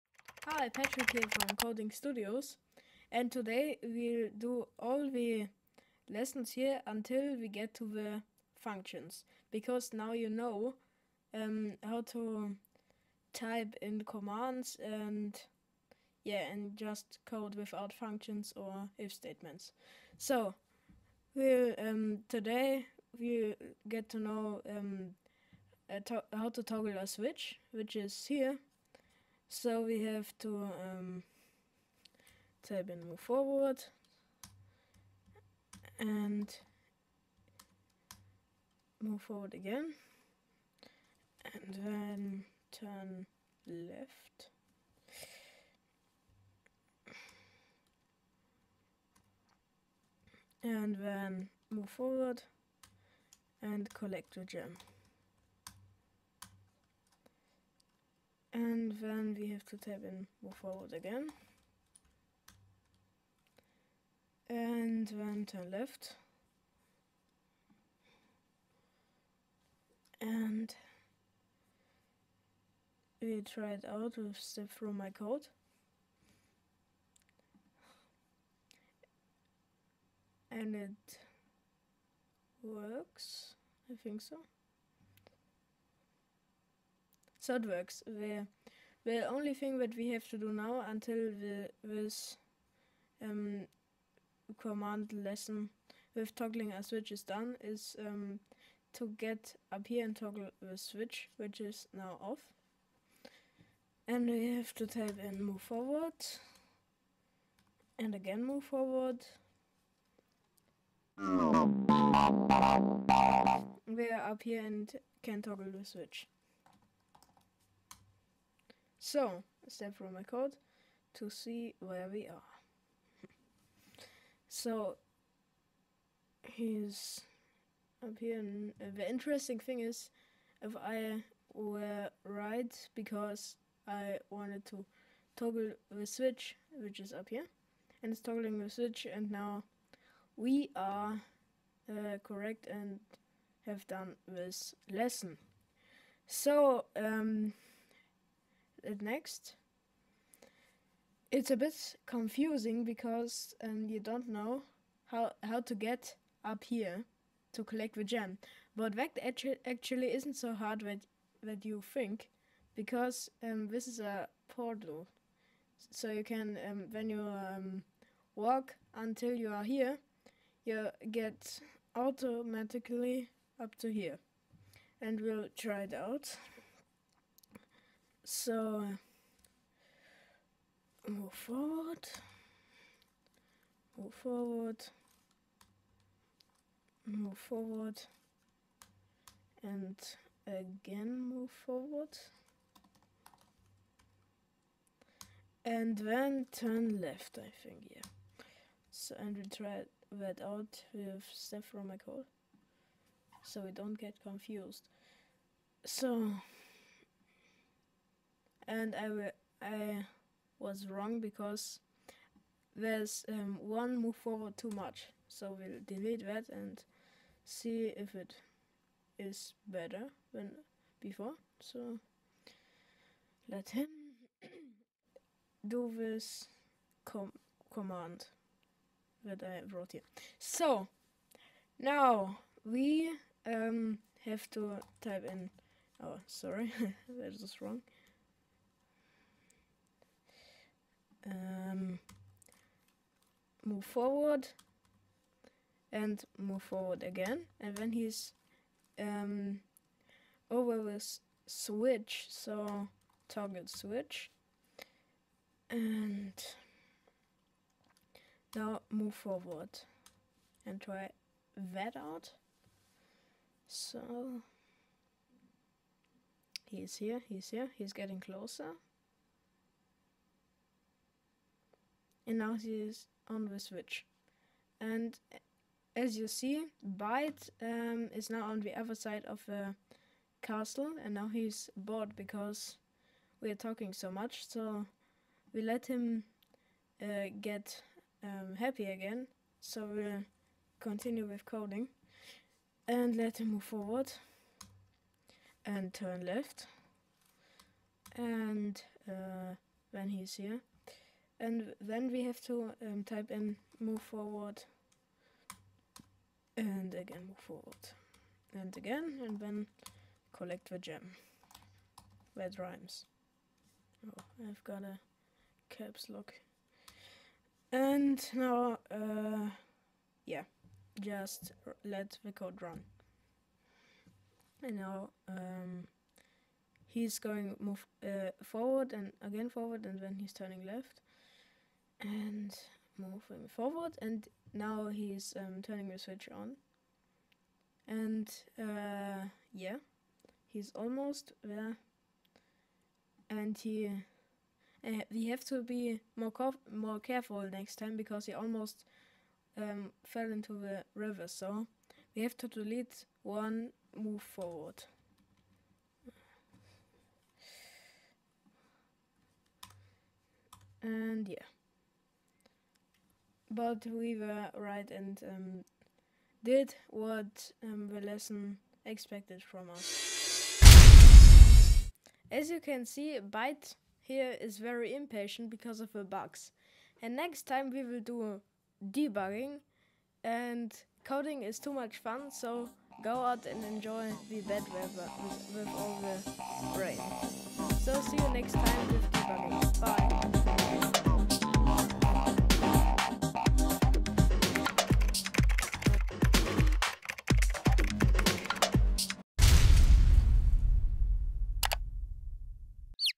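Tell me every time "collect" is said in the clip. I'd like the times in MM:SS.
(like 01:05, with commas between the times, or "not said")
00:53, 02:37, 05:10.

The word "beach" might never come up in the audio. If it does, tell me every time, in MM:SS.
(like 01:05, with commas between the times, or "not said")
not said.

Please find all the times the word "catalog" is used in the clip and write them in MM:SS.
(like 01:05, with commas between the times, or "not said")
not said.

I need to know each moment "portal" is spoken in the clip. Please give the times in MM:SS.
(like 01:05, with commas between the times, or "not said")
02:44.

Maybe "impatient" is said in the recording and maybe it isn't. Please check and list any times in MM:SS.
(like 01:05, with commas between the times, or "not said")
06:14.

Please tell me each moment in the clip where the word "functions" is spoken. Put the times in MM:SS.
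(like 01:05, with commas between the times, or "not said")
00:08, 00:17.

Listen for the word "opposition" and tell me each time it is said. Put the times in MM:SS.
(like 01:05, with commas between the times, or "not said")
not said.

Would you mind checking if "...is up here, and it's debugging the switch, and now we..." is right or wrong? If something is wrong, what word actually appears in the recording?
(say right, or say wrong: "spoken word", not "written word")
wrong: "toggling", not "debugging".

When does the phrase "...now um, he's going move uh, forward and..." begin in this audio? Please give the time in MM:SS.
05:24.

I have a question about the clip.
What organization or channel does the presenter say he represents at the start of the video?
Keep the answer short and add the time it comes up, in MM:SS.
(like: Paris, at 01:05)
Coding Studios, at 00:01.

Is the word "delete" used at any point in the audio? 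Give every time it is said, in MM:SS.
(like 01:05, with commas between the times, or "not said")
03:35, 05:52.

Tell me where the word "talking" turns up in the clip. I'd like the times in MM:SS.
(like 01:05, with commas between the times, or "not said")
04:43.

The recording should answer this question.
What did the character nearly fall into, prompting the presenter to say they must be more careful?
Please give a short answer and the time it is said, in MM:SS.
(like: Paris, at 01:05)
the river, at 05:50.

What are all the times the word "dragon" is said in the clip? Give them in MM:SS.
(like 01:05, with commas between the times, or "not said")
not said.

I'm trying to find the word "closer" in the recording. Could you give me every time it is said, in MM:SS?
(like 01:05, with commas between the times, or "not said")
04:28.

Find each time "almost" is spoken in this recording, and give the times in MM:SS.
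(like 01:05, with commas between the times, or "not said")
05:40, 05:48.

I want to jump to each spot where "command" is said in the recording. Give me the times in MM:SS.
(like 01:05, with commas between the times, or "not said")
00:14, 01:34, 03:47.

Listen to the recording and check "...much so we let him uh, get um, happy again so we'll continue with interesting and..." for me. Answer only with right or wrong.
wrong.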